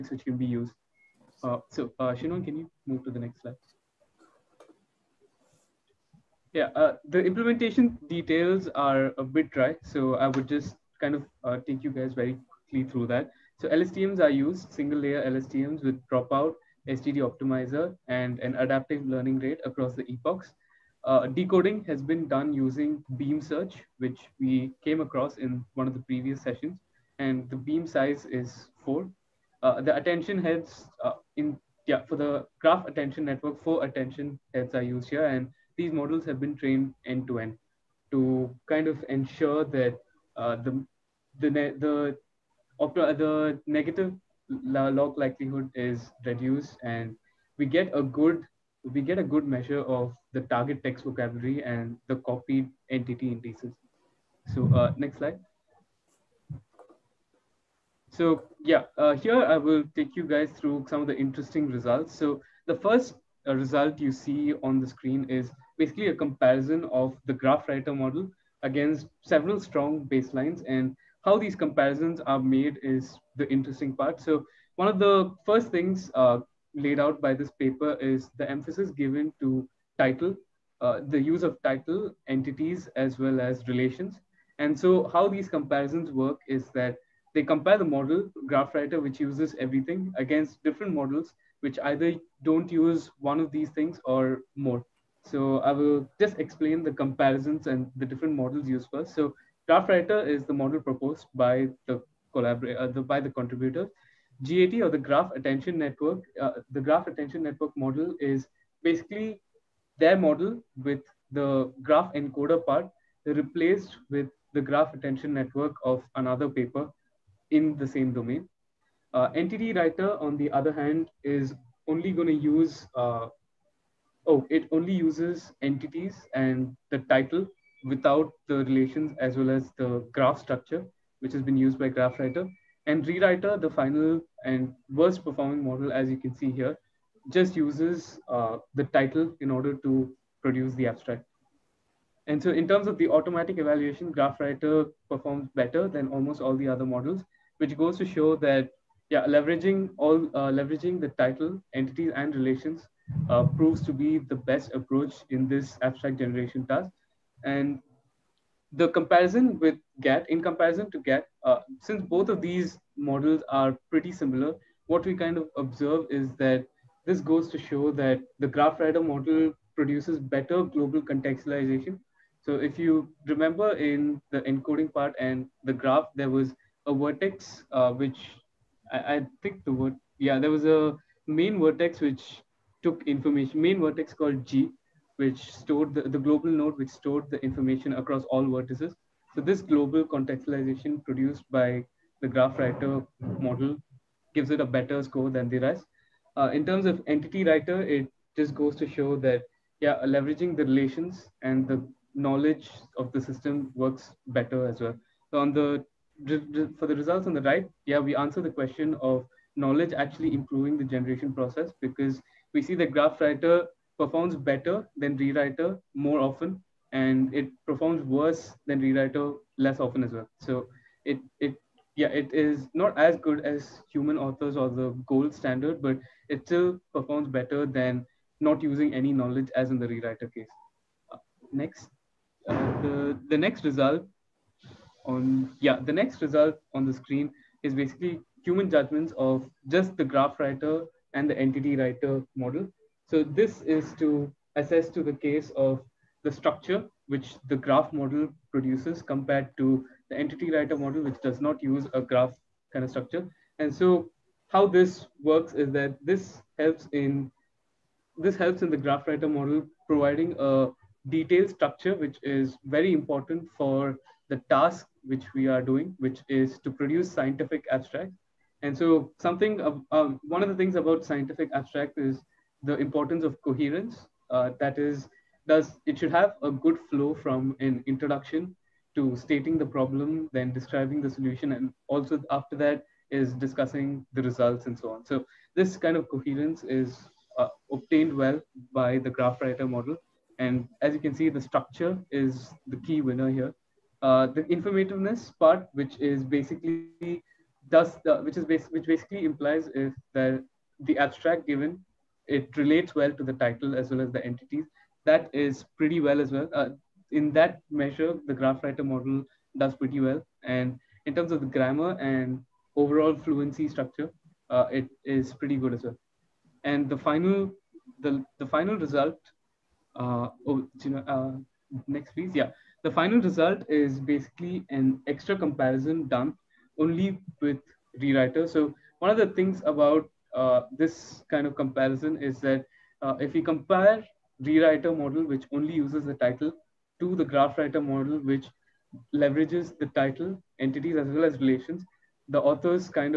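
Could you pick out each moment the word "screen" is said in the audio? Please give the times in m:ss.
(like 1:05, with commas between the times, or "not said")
1:04, 3:56.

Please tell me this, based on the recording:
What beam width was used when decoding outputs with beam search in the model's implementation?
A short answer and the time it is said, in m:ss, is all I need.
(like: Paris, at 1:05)
4, at 0:27.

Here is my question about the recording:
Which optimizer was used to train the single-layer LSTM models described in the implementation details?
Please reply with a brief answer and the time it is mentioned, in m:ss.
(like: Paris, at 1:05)
SGD, at 0:16.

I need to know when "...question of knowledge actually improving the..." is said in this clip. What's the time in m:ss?
3:28.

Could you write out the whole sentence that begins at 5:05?
That is pretty well as well.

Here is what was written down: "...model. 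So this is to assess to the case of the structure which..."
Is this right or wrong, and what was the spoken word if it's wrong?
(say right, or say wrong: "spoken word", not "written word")
right.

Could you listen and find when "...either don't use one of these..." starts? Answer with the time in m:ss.
1:31.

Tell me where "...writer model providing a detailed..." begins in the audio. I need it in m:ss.
4:19.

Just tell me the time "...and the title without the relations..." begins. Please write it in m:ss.
2:06.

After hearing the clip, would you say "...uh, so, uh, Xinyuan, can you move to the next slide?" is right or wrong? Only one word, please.
right.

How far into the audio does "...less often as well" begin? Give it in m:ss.
3:39.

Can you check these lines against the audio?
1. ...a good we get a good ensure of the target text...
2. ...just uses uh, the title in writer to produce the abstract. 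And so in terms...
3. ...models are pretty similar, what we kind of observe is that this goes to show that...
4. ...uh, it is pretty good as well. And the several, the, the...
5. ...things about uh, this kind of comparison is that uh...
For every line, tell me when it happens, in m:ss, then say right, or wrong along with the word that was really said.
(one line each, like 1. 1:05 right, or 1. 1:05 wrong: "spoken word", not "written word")
1. 0:47 wrong: "measure", not "ensure"
2. 2:17 wrong: "order", not "writer"
3. 2:42 right
4. 5:14 wrong: "final", not "several"
5. 5:29 right.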